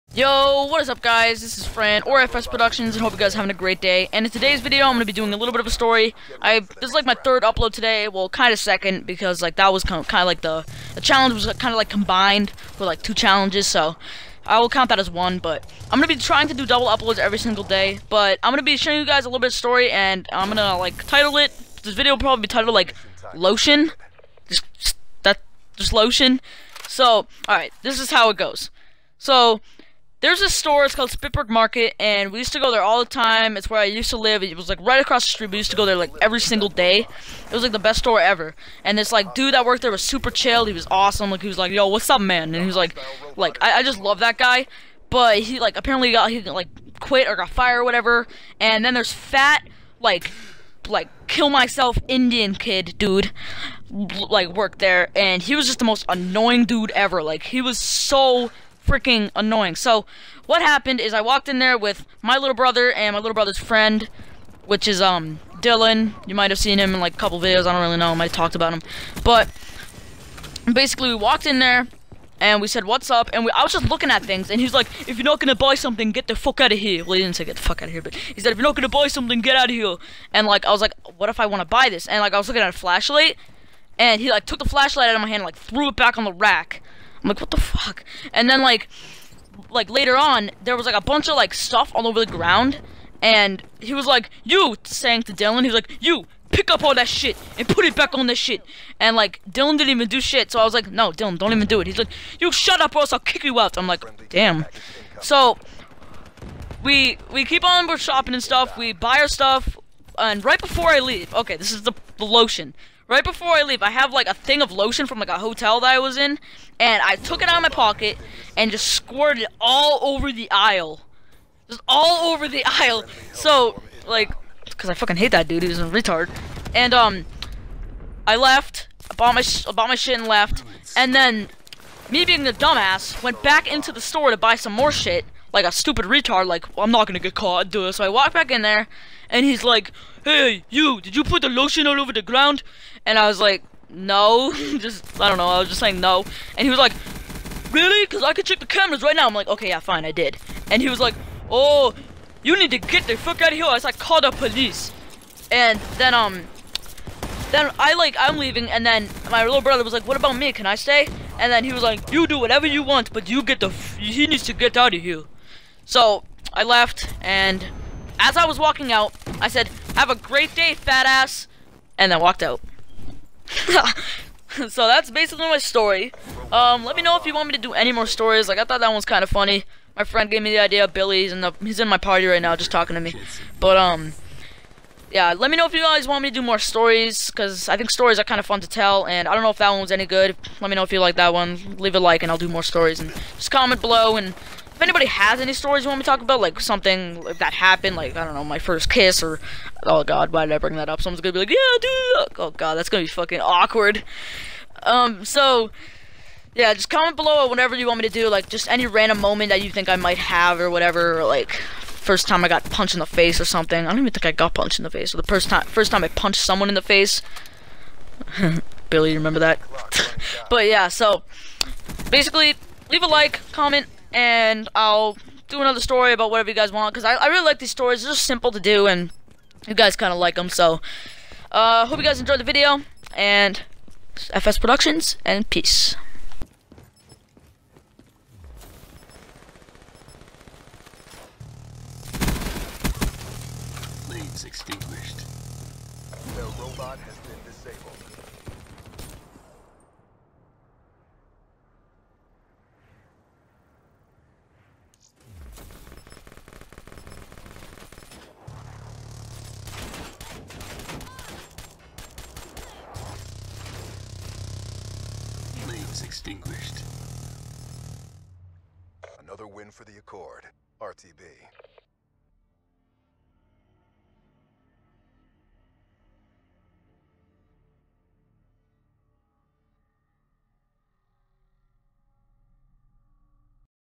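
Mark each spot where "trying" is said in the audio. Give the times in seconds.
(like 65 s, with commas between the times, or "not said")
16 s.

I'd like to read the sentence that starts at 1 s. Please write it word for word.
This is Fern, or FS Productions, and hope you guys are having a great day.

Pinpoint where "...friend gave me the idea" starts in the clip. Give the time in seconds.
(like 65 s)
180 s.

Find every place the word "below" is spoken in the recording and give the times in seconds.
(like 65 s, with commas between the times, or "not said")
193 s, 207 s.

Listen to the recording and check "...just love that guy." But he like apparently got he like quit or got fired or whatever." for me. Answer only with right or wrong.
right.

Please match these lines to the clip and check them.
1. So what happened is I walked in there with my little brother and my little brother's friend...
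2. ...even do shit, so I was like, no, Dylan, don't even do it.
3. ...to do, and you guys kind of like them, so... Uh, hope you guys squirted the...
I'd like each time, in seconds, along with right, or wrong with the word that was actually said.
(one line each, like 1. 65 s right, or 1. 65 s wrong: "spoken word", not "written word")
1. 59 s right
2. 99 s right
3. 228 s wrong: "enjoyed", not "squirted".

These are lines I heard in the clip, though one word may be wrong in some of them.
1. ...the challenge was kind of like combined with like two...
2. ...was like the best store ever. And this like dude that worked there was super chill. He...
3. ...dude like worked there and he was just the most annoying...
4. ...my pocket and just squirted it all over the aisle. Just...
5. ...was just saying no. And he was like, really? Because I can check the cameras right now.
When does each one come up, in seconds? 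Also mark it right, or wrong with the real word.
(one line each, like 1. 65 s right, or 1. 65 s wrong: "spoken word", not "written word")
1. 10 s right
2. 37 s right
3. 52 s right
4. 117 s right
5. 145 s right.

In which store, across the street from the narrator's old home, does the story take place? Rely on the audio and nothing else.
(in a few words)
Spitberg Market.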